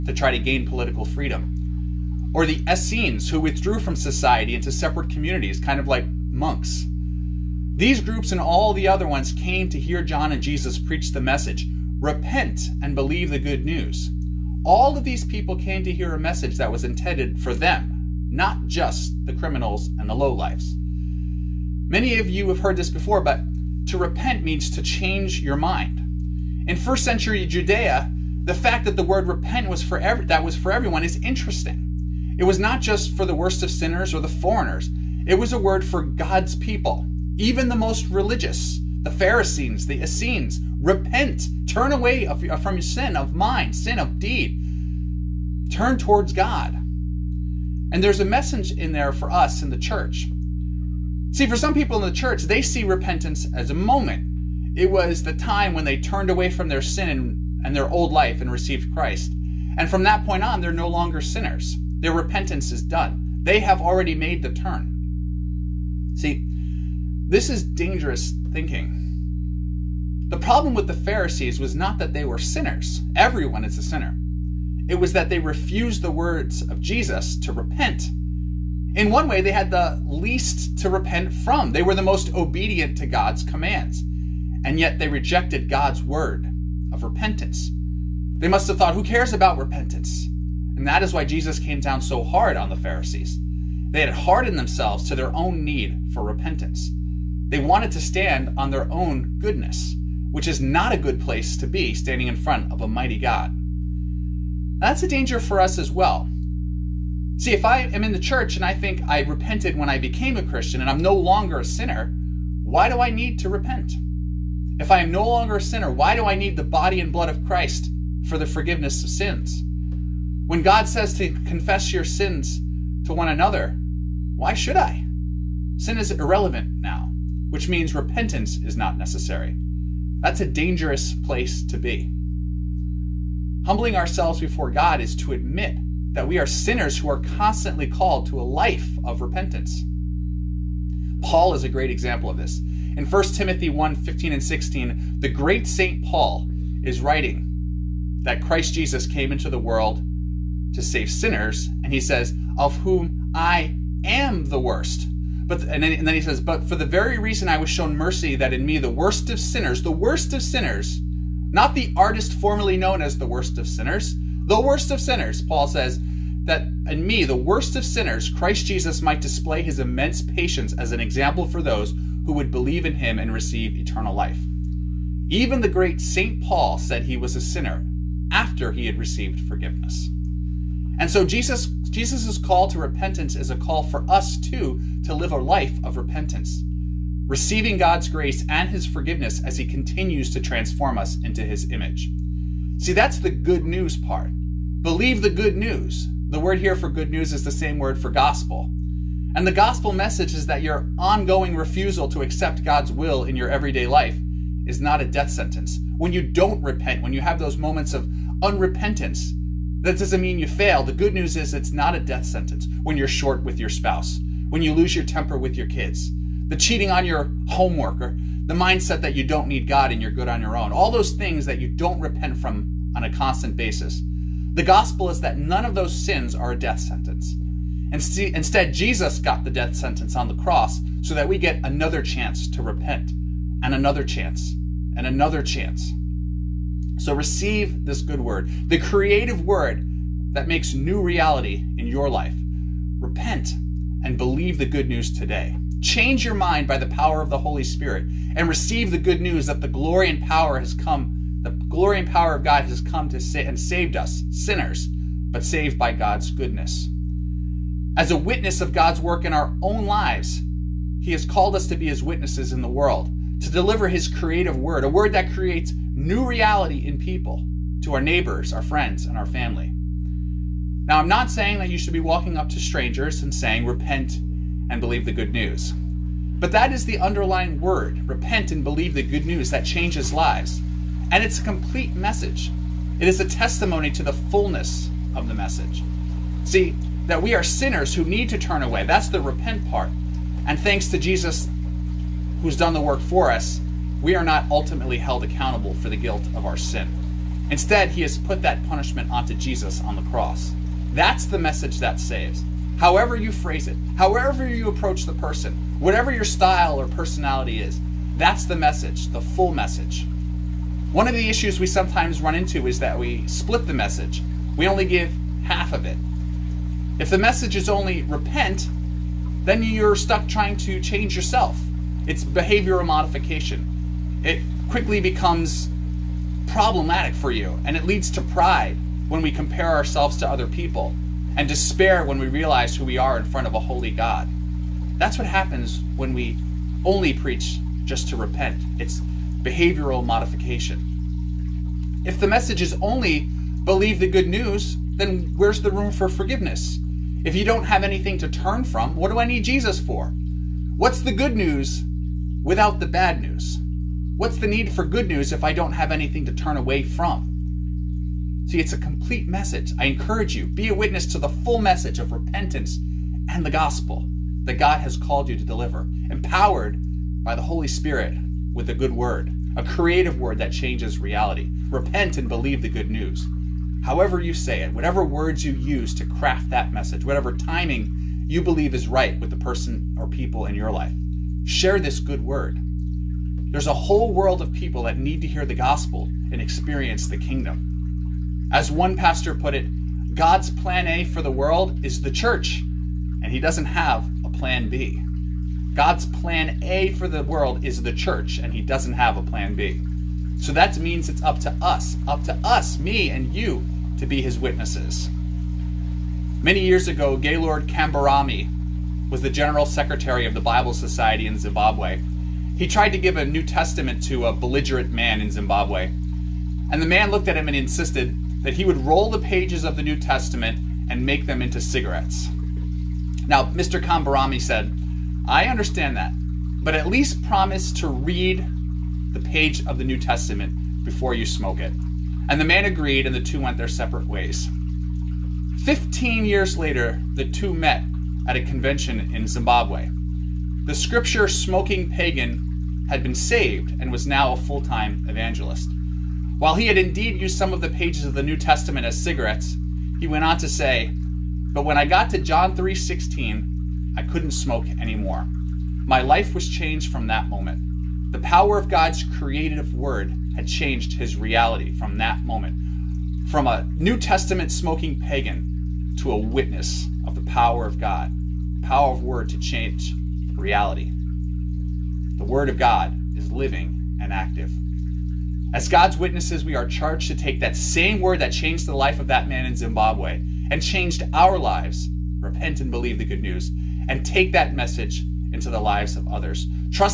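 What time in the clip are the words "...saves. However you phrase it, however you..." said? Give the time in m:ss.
5:01.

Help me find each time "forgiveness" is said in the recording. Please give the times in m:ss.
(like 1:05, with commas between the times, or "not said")
1:58, 2:59, 3:08, 5:46.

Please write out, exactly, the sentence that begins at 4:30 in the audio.
Now, I'm not saying that you should be walking up to strangers and saying, repent and believe the good news.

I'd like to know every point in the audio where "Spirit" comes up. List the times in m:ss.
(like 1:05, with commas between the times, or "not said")
4:07, 6:07.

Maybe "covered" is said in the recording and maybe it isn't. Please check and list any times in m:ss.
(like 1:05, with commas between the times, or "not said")
not said.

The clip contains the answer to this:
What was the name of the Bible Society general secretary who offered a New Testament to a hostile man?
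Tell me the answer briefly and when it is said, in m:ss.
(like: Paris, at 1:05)
Gaylord Kambarami, at 6:47.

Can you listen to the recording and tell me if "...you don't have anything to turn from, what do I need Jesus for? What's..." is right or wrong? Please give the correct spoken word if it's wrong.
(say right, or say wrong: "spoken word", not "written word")
right.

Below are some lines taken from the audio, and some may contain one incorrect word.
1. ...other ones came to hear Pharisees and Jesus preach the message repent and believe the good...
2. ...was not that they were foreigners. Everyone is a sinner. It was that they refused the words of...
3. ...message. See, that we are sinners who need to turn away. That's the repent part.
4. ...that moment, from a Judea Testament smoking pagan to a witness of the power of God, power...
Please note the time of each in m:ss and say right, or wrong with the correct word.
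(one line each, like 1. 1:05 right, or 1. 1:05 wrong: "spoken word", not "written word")
1. 0:08 wrong: "John", not "Pharisees"
2. 1:11 wrong: "sinners", not "foreigners"
3. 4:45 right
4. 7:41 wrong: "New", not "Judea".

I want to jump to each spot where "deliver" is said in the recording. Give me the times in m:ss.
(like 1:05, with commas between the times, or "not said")
4:23, 6:05.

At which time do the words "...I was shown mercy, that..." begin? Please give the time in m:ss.
2:37.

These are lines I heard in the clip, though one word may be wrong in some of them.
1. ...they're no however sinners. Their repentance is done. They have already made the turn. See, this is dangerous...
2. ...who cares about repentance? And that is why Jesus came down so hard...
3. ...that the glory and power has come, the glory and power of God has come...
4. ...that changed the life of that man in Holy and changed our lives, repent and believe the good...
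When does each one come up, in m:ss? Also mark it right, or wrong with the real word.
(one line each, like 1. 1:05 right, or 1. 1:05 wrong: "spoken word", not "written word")
1. 1:00 wrong: "longer", not "however"
2. 1:28 right
3. 4:09 right
4. 7:58 wrong: "Zimbabwe", not "Holy".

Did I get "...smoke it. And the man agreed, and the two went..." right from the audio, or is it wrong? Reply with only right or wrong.
right.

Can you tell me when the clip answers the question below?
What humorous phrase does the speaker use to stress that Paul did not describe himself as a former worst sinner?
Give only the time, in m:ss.
2:41.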